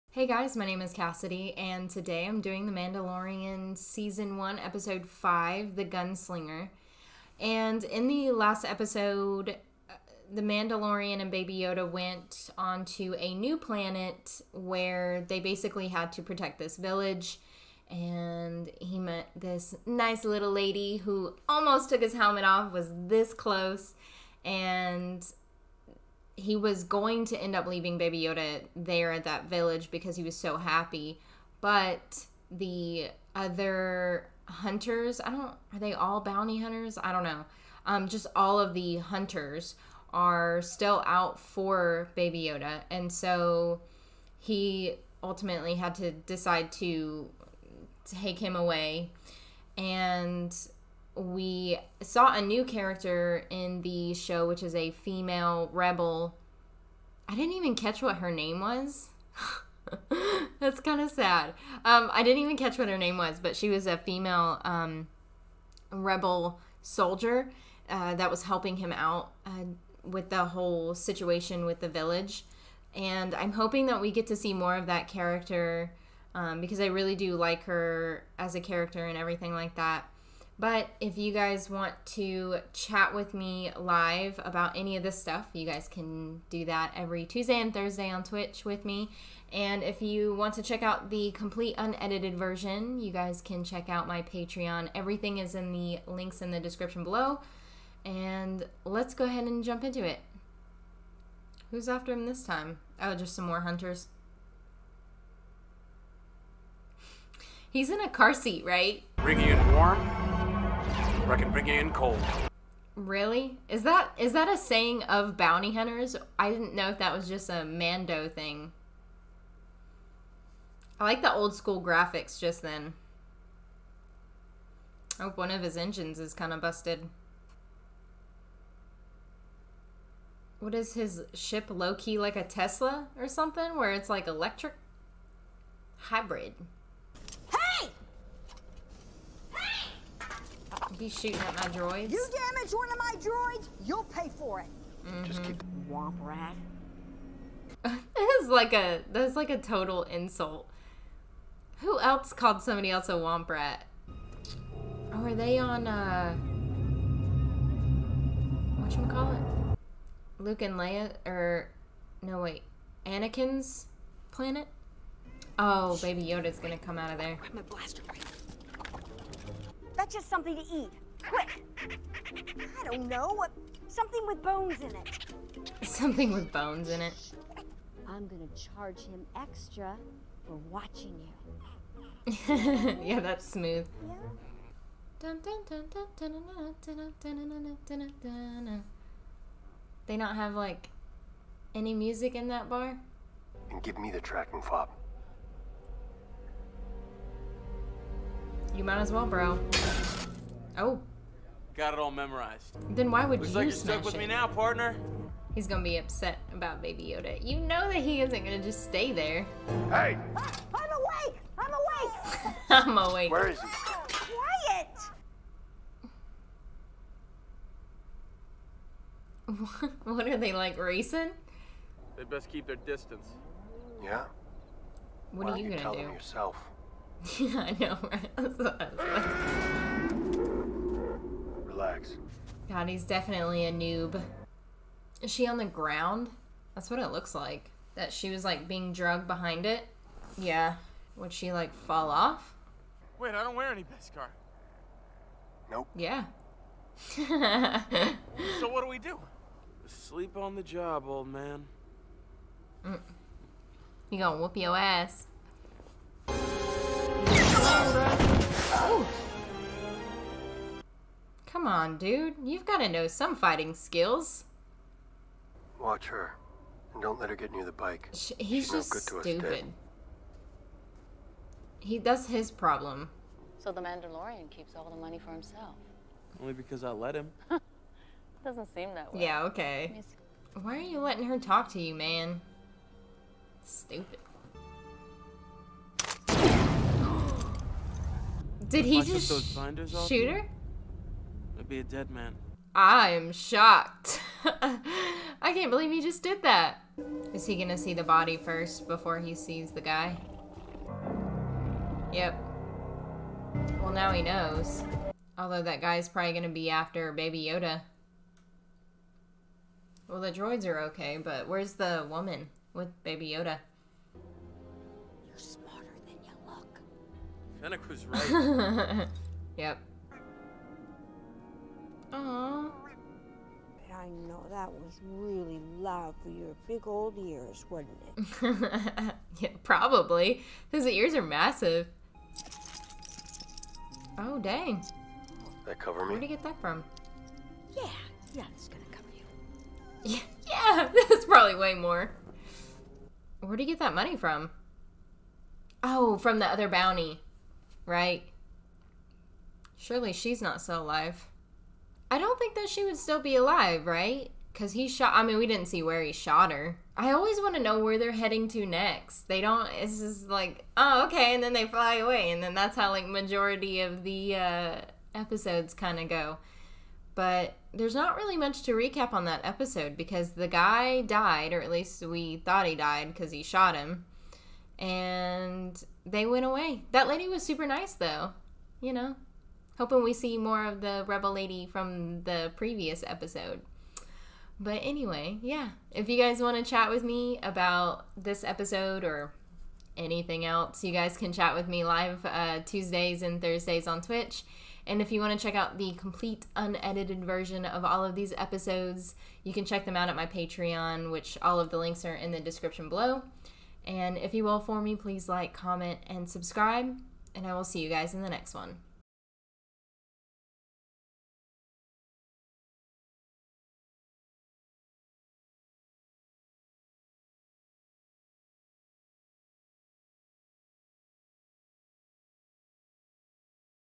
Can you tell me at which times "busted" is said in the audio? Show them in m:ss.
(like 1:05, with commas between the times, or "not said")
2:06.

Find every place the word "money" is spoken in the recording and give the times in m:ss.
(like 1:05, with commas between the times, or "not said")
4:34, 5:43.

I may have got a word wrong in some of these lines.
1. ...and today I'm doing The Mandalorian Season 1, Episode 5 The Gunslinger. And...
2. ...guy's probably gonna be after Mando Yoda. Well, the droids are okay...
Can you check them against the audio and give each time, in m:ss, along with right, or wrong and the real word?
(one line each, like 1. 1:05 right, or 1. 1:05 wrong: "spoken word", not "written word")
1. 0:01 right
2. 5:05 wrong: "Baby", not "Mando".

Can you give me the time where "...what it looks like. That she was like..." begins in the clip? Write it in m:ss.
3:56.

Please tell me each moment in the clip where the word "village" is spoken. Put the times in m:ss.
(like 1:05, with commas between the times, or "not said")
0:16, 0:29, 1:11.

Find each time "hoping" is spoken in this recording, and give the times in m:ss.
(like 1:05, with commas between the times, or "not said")
1:13, 6:19.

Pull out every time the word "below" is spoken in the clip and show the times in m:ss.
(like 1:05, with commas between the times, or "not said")
1:37, 6:42.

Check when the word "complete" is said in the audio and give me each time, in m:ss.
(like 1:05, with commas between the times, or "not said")
1:31, 6:35.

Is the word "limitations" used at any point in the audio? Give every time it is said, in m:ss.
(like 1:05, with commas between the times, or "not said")
not said.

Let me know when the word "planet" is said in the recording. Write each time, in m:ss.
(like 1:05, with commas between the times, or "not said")
0:13, 2:44.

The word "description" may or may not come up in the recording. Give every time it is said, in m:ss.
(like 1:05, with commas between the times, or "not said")
1:36, 6:42.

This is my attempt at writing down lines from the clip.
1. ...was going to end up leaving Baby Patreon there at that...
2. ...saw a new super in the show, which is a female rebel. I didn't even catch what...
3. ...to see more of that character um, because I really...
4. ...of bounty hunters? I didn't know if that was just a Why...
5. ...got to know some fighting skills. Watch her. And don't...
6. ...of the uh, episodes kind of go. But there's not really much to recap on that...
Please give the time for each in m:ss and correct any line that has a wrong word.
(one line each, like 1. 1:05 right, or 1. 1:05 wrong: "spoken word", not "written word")
1. 0:26 wrong: "Yoda", not "Patreon"
2. 0:52 wrong: "character", not "super"
3. 1:14 right
4. 1:55 wrong: "Mando", not "Why"
5. 4:22 right
6. 6:03 right.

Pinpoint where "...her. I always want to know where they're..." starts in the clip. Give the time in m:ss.
5:56.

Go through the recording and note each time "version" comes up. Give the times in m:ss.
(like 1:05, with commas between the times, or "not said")
1:32, 6:37.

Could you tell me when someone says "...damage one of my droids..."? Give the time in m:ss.
2:22.